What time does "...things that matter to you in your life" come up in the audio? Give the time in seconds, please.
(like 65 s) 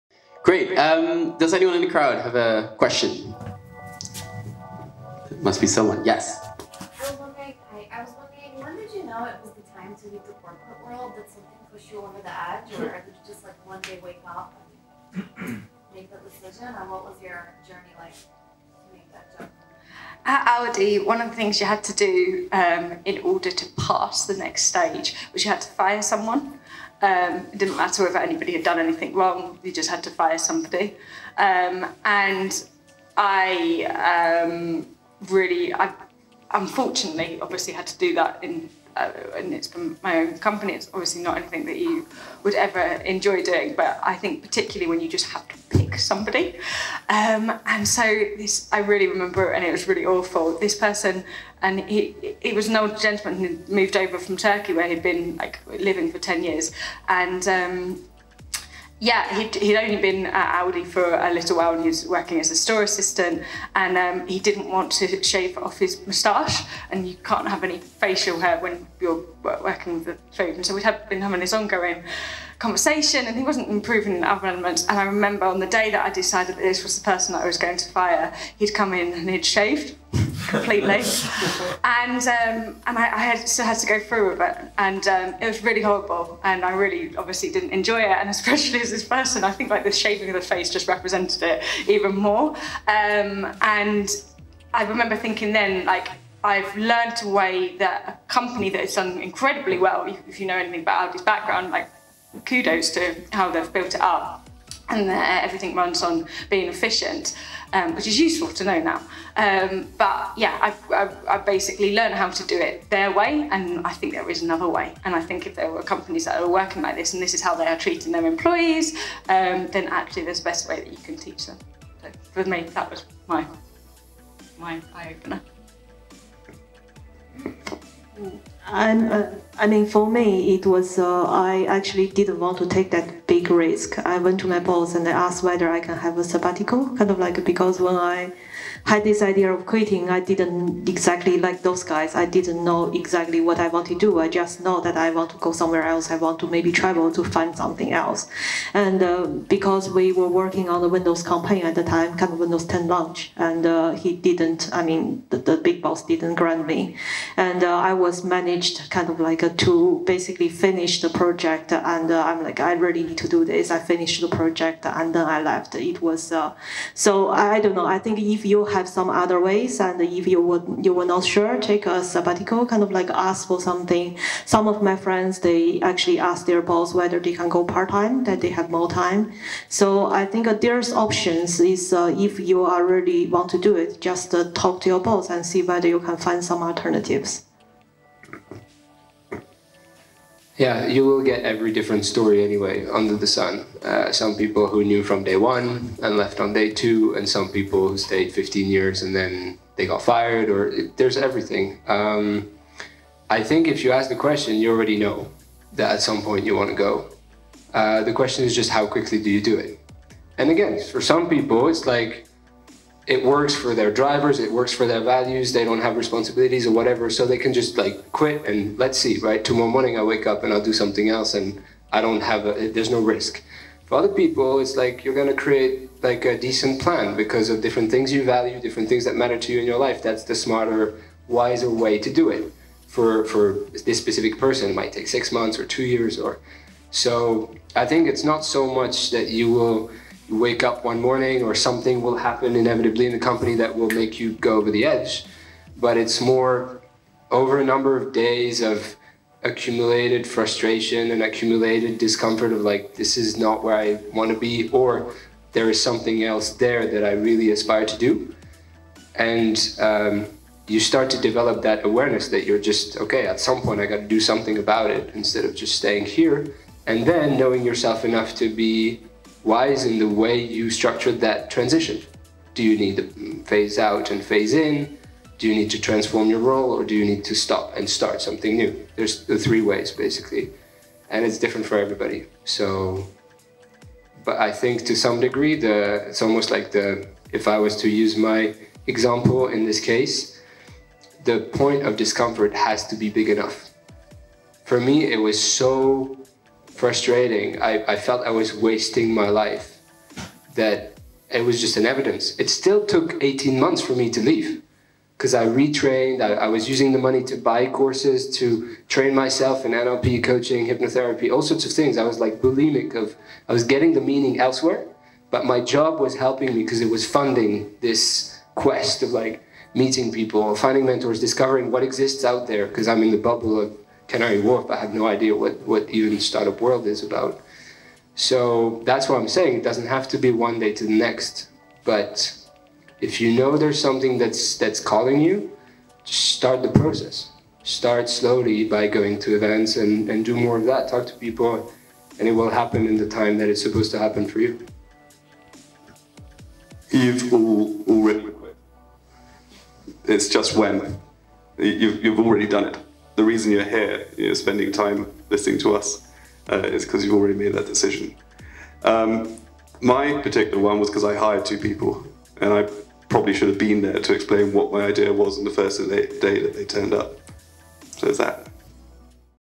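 228 s.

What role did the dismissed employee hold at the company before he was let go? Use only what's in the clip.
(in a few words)
Store assistant.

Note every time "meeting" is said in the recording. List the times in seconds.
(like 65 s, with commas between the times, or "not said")
319 s.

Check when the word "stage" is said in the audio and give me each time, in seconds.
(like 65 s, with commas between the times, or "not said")
24 s.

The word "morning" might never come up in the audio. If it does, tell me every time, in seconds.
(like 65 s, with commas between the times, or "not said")
219 s, 241 s.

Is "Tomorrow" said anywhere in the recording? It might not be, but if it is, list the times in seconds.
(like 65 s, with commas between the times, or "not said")
219 s.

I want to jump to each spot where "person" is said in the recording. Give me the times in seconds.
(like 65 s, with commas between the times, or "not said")
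50 s, 77 s, 89 s, 234 s.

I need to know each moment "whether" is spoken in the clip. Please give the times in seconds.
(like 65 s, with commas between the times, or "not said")
135 s, 176 s, 185 s.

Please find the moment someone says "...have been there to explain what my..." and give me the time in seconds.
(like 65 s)
363 s.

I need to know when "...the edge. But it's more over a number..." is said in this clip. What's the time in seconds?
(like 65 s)
244 s.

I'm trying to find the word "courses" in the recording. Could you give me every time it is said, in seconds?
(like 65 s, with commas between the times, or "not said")
307 s.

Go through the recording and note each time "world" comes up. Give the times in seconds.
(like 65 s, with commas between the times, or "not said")
10 s, 326 s.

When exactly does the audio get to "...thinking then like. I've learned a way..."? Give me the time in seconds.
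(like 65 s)
95 s.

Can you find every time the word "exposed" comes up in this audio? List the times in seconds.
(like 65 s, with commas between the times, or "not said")
not said.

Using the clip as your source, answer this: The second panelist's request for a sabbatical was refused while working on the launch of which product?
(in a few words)
Windows 10.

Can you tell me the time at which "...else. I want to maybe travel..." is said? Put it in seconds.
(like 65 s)
145 s.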